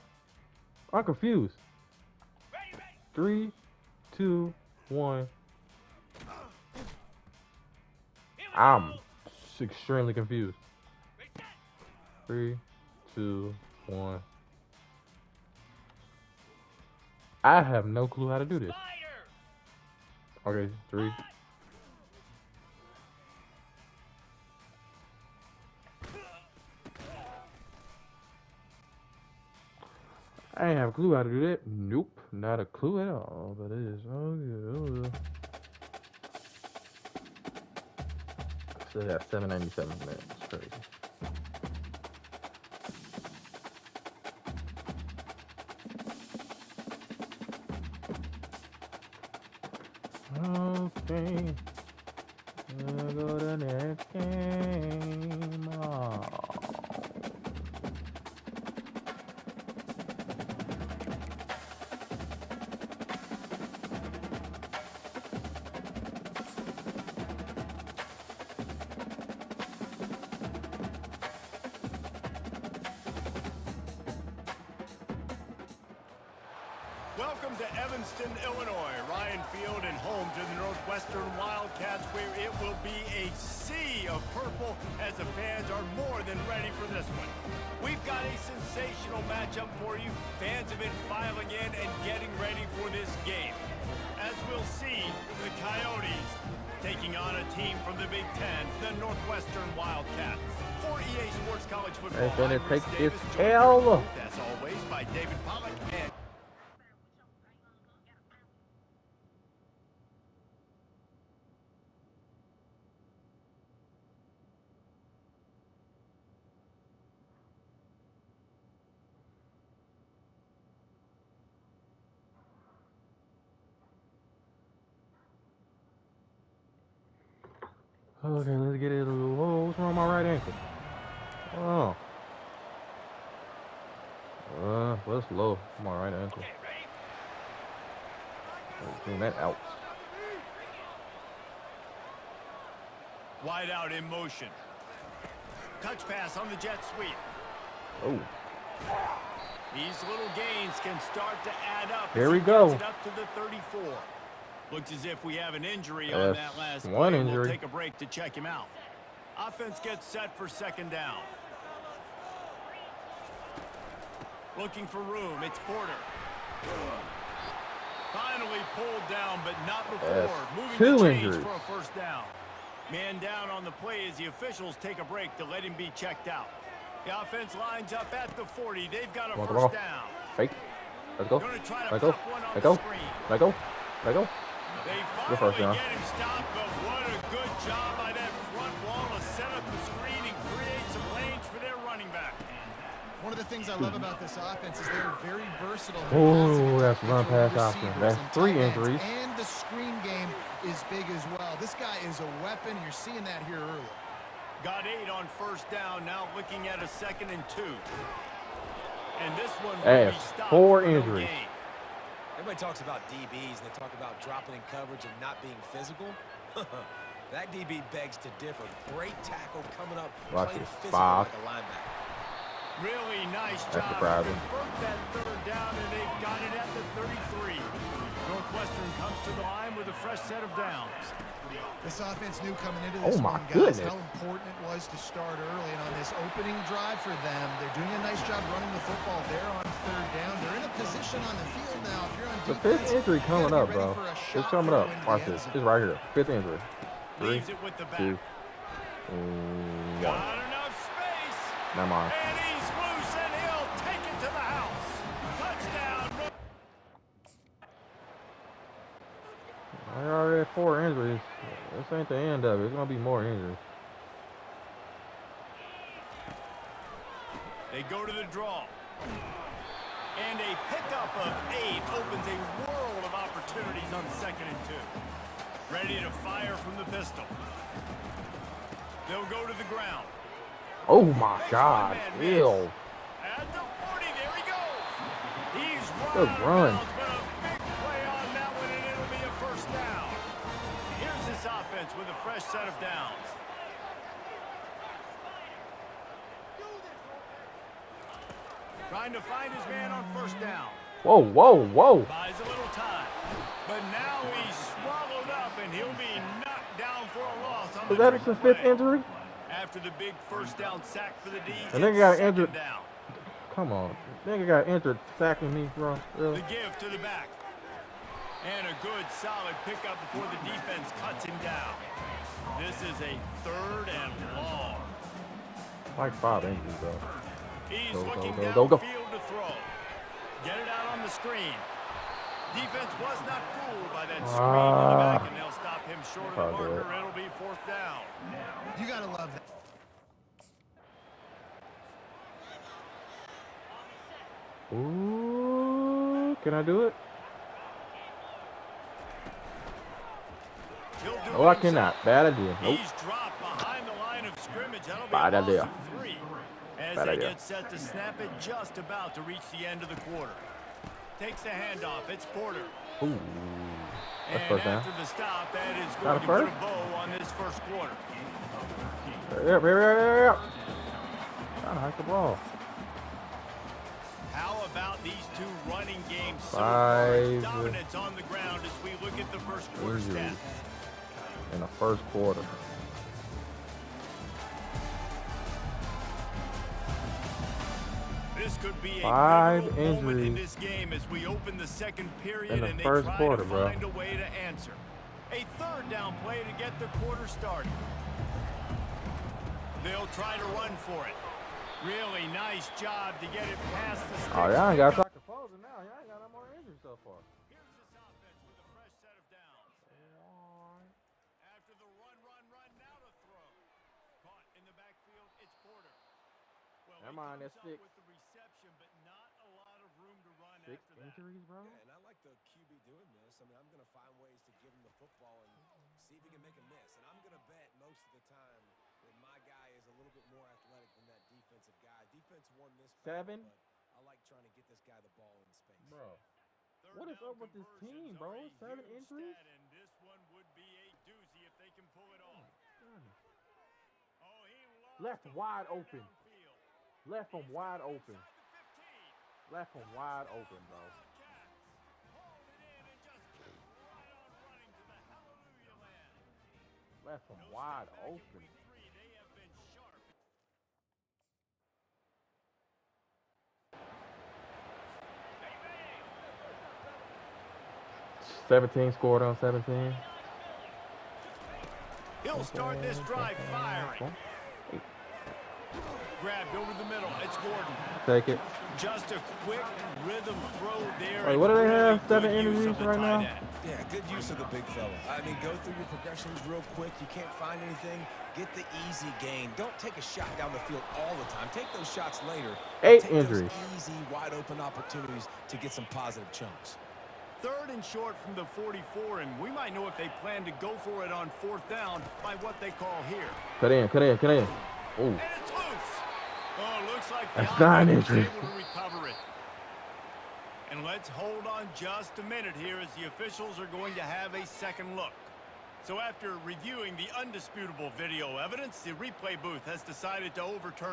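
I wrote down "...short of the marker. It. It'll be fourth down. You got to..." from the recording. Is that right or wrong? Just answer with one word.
right.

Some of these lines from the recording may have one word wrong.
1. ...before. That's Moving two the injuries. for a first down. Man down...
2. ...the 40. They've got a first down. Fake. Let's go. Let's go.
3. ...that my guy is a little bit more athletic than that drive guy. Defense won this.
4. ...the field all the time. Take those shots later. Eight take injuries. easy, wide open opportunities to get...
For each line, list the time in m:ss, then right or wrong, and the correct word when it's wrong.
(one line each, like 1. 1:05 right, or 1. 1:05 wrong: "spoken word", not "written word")
1. 2:49 right
2. 2:58 right
3. 7:09 wrong: "defensive", not "drive"
4. 8:10 right.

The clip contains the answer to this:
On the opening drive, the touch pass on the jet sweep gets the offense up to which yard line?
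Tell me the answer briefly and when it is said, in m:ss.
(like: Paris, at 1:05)
34, at 2:33.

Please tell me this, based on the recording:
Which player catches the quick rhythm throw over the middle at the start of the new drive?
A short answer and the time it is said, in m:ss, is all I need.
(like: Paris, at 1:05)
Gordon, at 7:57.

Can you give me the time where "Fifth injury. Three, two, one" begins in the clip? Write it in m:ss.
4:06.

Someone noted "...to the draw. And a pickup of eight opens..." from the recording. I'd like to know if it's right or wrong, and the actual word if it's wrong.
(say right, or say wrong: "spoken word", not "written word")
right.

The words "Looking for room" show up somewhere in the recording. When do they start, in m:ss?
2:44.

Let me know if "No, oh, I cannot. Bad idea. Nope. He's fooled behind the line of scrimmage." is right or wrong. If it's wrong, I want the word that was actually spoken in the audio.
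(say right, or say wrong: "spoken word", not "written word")
wrong: "dropped", not "fooled".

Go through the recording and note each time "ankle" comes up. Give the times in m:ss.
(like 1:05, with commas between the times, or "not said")
2:10, 2:16.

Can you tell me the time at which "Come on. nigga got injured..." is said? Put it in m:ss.
5:13.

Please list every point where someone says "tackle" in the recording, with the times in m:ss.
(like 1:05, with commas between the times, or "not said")
3:39.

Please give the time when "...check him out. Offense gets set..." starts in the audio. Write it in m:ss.
2:38.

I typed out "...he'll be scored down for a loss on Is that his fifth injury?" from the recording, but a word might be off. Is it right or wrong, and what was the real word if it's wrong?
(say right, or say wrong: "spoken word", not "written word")
wrong: "knocked", not "scored".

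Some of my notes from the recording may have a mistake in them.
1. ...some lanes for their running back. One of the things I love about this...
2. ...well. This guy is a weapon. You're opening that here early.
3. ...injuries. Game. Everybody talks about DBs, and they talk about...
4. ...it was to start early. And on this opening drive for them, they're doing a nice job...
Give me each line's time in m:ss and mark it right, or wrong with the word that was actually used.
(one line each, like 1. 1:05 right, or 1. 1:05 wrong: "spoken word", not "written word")
1. 3:10 right
2. 3:21 wrong: "seeing", not "opening"
3. 3:30 right
4. 3:54 right.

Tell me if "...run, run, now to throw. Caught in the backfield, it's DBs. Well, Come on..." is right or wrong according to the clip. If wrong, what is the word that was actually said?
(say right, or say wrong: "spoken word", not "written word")
wrong: "Porter", not "DBs".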